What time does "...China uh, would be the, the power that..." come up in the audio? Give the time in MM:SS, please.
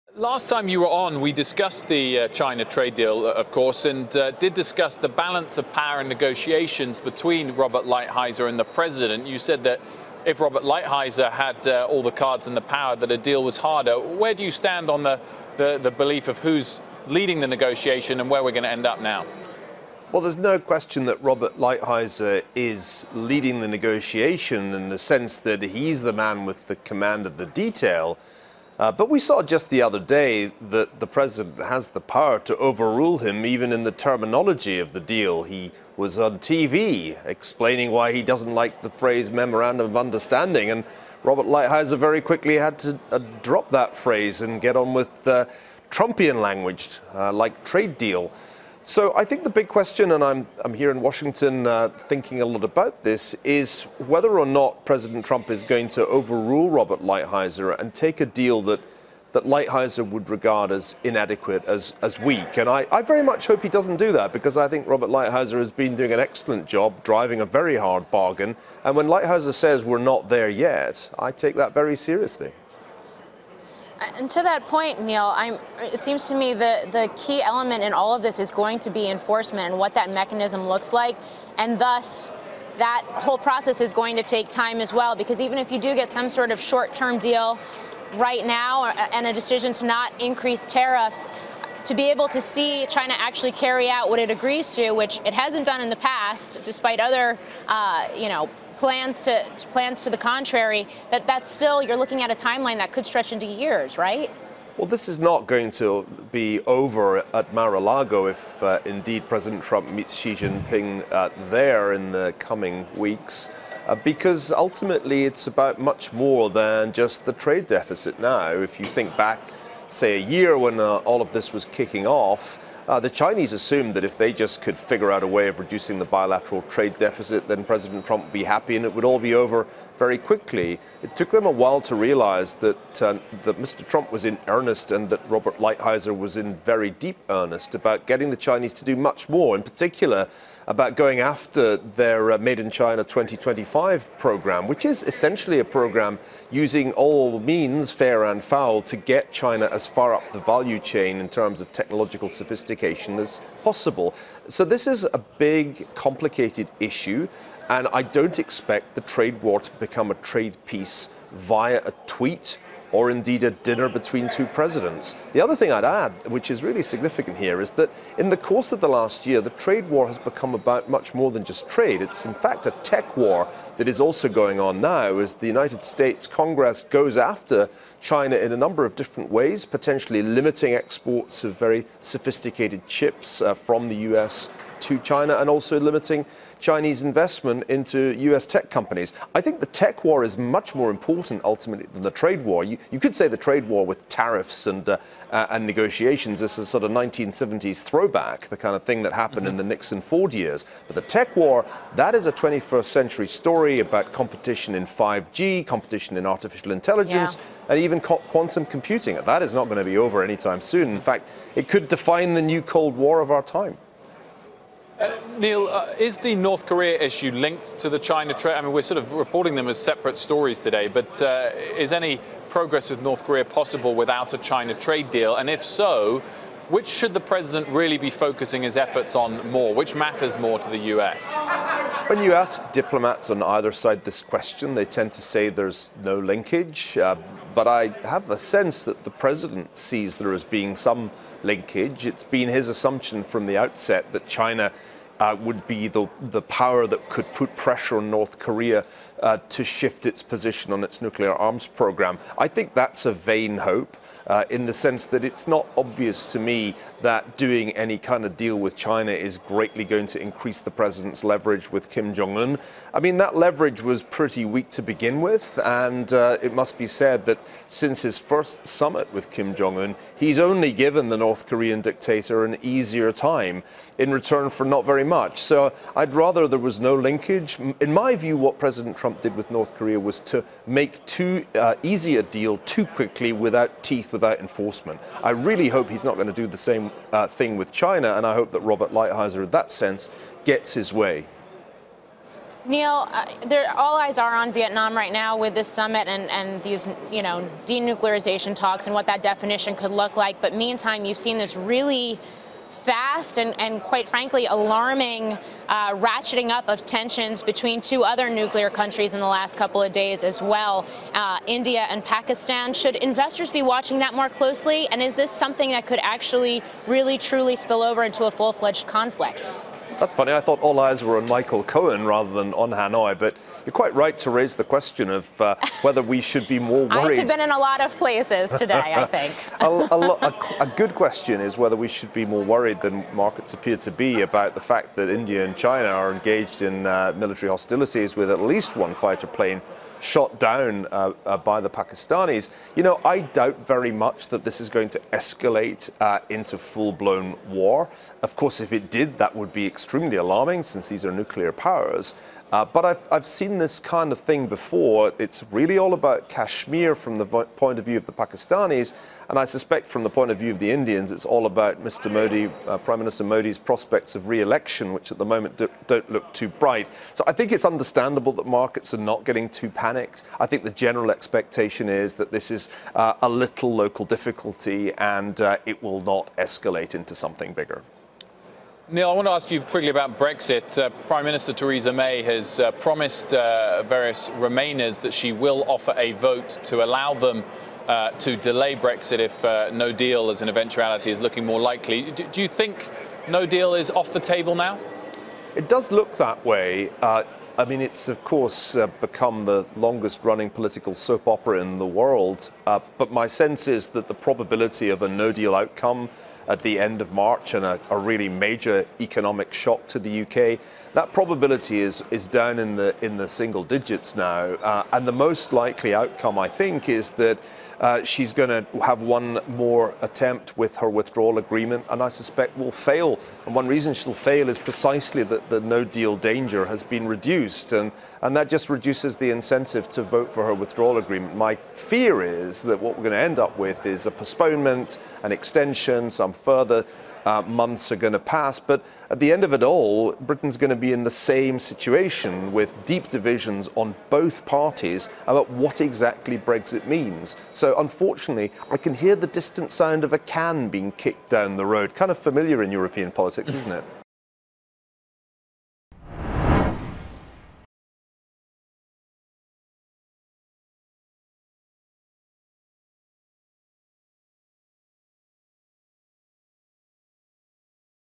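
04:04.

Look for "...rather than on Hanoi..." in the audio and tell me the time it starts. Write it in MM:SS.
05:22.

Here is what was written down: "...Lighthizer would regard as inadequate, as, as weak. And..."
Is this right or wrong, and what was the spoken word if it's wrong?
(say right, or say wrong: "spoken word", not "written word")
right.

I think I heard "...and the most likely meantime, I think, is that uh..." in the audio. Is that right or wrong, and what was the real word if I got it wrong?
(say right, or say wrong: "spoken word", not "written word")
wrong: "outcome", not "meantime".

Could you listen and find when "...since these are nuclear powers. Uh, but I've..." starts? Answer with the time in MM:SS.
05:50.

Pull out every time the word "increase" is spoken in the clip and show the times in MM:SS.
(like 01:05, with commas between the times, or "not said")
01:30, 04:20.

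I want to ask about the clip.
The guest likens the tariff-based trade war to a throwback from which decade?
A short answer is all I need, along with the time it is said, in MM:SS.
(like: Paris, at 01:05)
1970s, at 03:16.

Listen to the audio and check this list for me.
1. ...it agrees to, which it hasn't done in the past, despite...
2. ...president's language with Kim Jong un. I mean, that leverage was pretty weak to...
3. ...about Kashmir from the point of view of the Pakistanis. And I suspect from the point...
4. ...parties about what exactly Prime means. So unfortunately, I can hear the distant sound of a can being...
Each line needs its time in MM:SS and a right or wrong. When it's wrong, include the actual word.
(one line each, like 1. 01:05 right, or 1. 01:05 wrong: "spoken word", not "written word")
1. 01:34 right
2. 04:20 wrong: "leverage", not "language"
3. 05:55 right
4. 07:24 wrong: "Brexit", not "Prime".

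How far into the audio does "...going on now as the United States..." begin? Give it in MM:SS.
02:54.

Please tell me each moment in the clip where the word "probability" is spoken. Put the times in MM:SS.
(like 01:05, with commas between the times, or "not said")
06:44, 06:51.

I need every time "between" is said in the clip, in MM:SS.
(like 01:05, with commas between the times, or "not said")
00:06, 02:43, 05:07.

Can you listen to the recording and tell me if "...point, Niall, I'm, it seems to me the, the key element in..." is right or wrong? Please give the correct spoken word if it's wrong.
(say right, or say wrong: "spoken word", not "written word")
right.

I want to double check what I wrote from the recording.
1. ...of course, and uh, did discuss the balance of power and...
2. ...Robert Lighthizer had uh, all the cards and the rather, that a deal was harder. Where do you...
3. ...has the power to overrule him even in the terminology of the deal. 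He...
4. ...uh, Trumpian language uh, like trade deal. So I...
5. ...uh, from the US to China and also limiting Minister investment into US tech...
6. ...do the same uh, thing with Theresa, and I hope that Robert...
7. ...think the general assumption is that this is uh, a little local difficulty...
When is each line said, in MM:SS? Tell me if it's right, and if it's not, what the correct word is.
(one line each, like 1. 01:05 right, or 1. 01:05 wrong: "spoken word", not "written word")
1. 00:03 right
2. 00:10 wrong: "power", not "rather"
3. 00:31 right
4. 00:45 right
5. 03:03 wrong: "Chinese", not "Minister"
6. 04:46 wrong: "China", not "Theresa"
7. 06:10 wrong: "expectation", not "assumption".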